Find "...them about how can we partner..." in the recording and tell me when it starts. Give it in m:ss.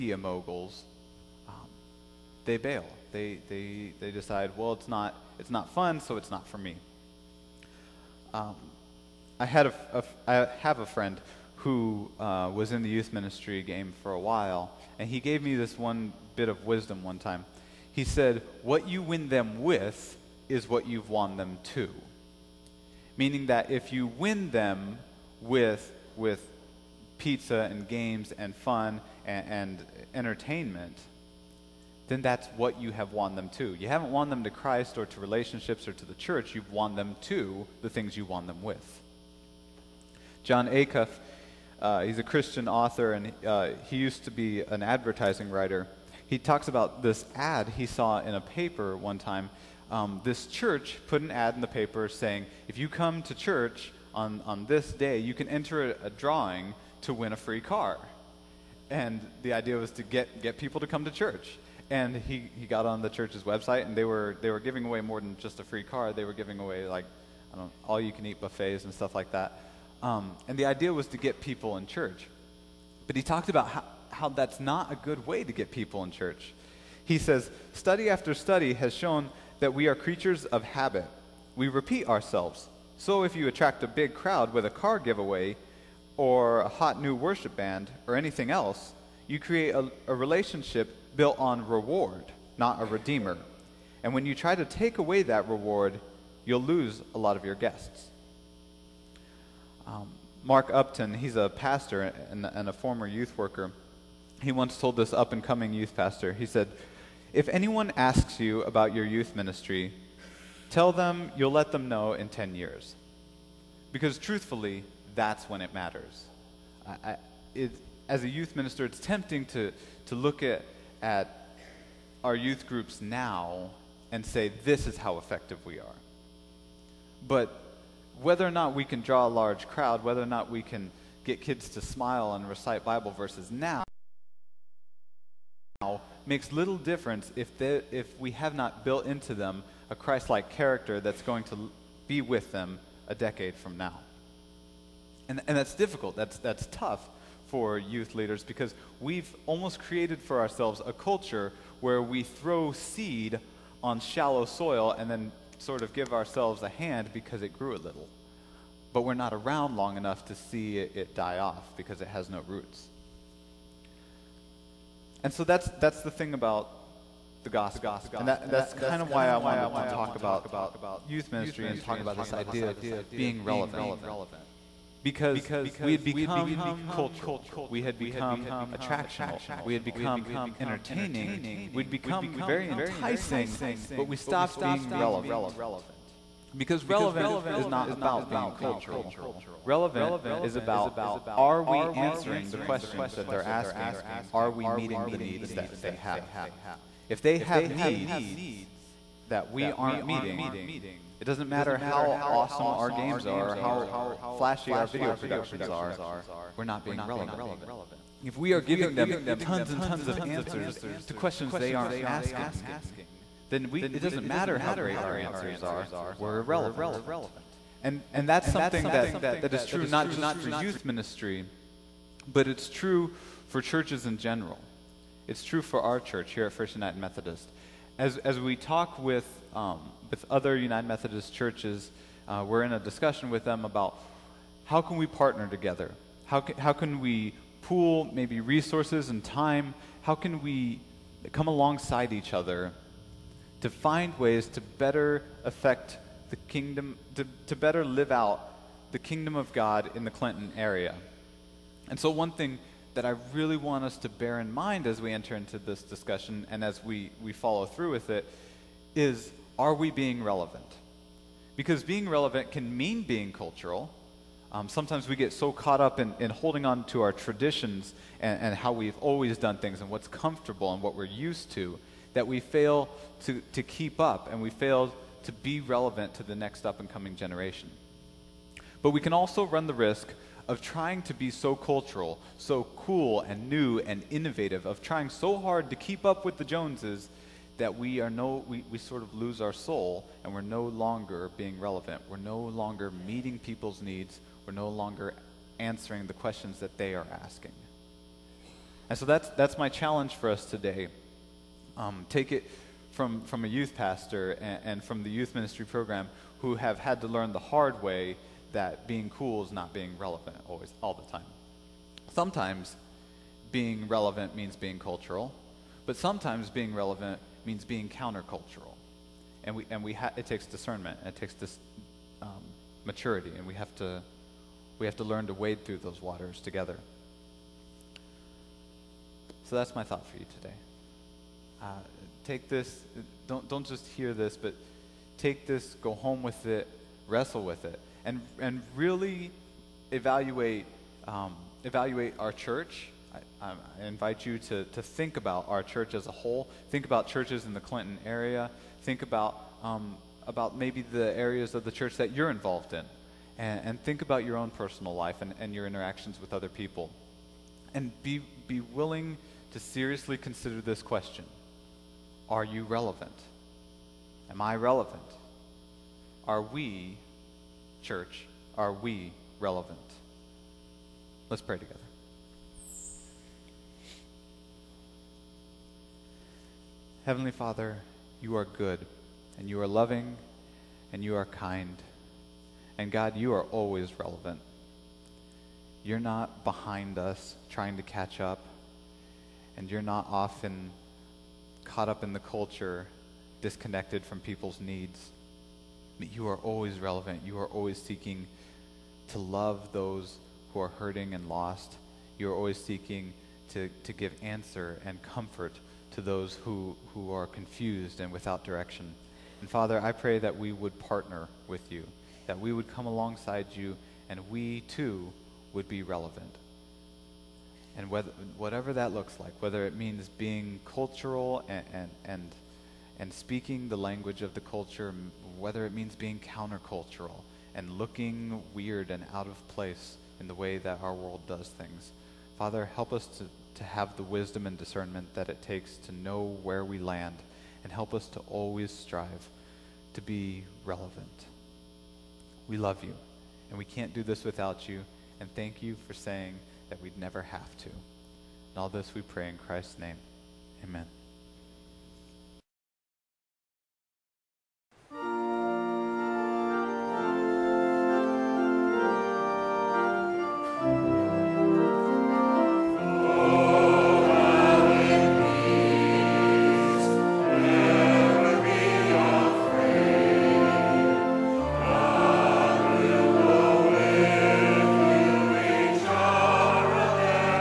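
3:53.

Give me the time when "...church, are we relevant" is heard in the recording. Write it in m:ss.
6:07.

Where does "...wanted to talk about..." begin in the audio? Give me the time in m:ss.
2:49.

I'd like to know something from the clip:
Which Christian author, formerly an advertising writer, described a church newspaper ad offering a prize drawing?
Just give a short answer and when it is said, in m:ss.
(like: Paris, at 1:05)
Jon Acuff, at 0:40.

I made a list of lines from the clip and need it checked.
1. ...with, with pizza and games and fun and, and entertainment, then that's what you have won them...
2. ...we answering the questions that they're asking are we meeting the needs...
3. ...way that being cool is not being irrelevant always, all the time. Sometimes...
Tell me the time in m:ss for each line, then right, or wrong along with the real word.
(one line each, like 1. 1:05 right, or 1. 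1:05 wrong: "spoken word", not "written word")
1. 0:25 right
2. 3:11 right
3. 5:07 wrong: "relevant", not "irrelevant".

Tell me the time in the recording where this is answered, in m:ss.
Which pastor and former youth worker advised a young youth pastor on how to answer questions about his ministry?
1:40.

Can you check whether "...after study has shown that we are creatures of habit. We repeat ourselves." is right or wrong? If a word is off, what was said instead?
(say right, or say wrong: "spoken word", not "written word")
right.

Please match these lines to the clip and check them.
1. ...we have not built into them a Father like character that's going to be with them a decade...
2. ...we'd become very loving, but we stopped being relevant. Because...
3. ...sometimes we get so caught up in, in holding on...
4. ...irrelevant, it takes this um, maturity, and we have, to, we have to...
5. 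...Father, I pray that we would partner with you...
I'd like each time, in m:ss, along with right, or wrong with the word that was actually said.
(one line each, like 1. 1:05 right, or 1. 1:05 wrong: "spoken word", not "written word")
1. 2:18 wrong: "Christ", not "Father"
2. 3:01 wrong: "enticing", not "loving"
3. 4:24 right
4. 5:20 wrong: "discernment", not "irrelevant"
5. 6:49 right.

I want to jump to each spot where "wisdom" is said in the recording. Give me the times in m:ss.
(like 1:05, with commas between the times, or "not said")
0:16, 7:14.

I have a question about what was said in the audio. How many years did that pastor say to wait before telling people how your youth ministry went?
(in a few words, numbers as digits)
10.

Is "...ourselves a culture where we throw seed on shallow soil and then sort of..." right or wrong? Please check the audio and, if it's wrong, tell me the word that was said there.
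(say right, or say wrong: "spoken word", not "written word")
right.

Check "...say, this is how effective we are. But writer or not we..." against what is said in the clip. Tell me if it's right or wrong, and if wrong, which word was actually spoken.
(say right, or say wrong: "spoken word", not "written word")
wrong: "whether", not "writer".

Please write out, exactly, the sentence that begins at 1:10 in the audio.
Um, and the idea was to get people in church.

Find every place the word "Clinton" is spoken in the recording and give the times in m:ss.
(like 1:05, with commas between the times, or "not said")
4:10, 5:47.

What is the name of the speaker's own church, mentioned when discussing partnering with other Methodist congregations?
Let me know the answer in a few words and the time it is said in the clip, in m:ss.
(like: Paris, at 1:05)
First United Methodist, at 3:46.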